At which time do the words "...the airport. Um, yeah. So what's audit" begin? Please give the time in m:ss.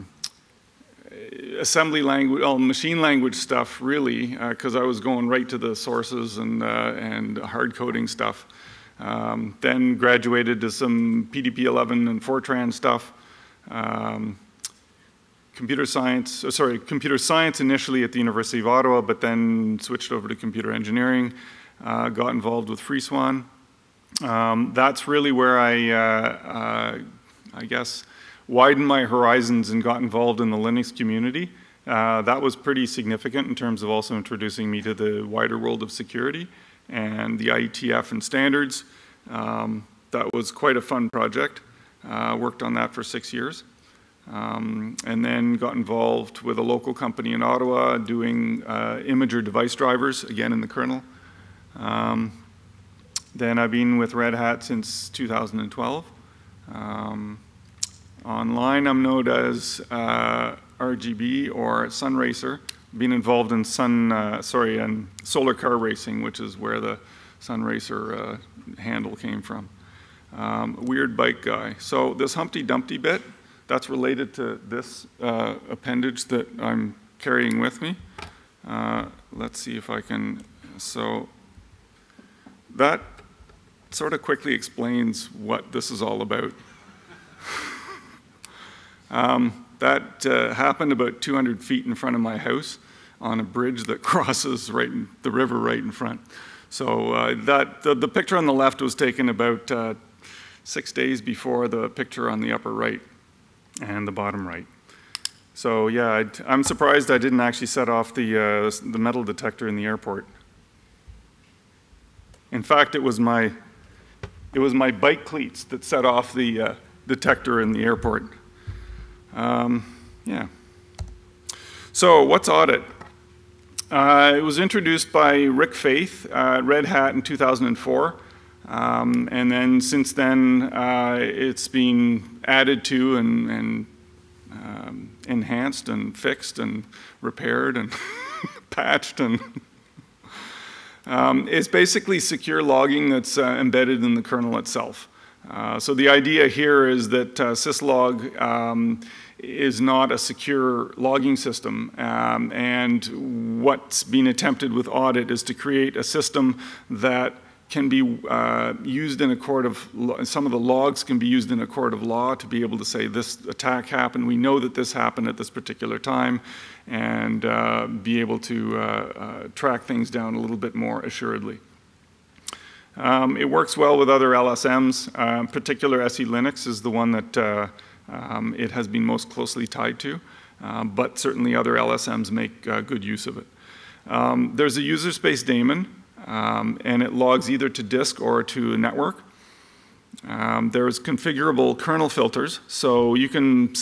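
1:57.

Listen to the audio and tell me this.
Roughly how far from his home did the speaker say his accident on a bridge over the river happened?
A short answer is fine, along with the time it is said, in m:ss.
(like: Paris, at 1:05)
200 feet, at 1:31.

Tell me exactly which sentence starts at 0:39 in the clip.
Um, that was quite a fun project uh, worked on that for six years.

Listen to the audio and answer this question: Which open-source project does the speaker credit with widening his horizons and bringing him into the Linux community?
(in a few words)
FreeS/WAN.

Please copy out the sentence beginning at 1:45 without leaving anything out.
So yeah, i am surprised I didn't actually set off the, uh, the metal detector in the airport.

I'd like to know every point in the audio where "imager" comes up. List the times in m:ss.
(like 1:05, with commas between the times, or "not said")
0:49.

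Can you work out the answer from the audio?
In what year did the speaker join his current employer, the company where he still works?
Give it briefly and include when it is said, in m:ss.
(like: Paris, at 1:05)
2012, at 0:55.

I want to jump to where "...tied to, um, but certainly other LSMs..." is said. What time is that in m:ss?
2:59.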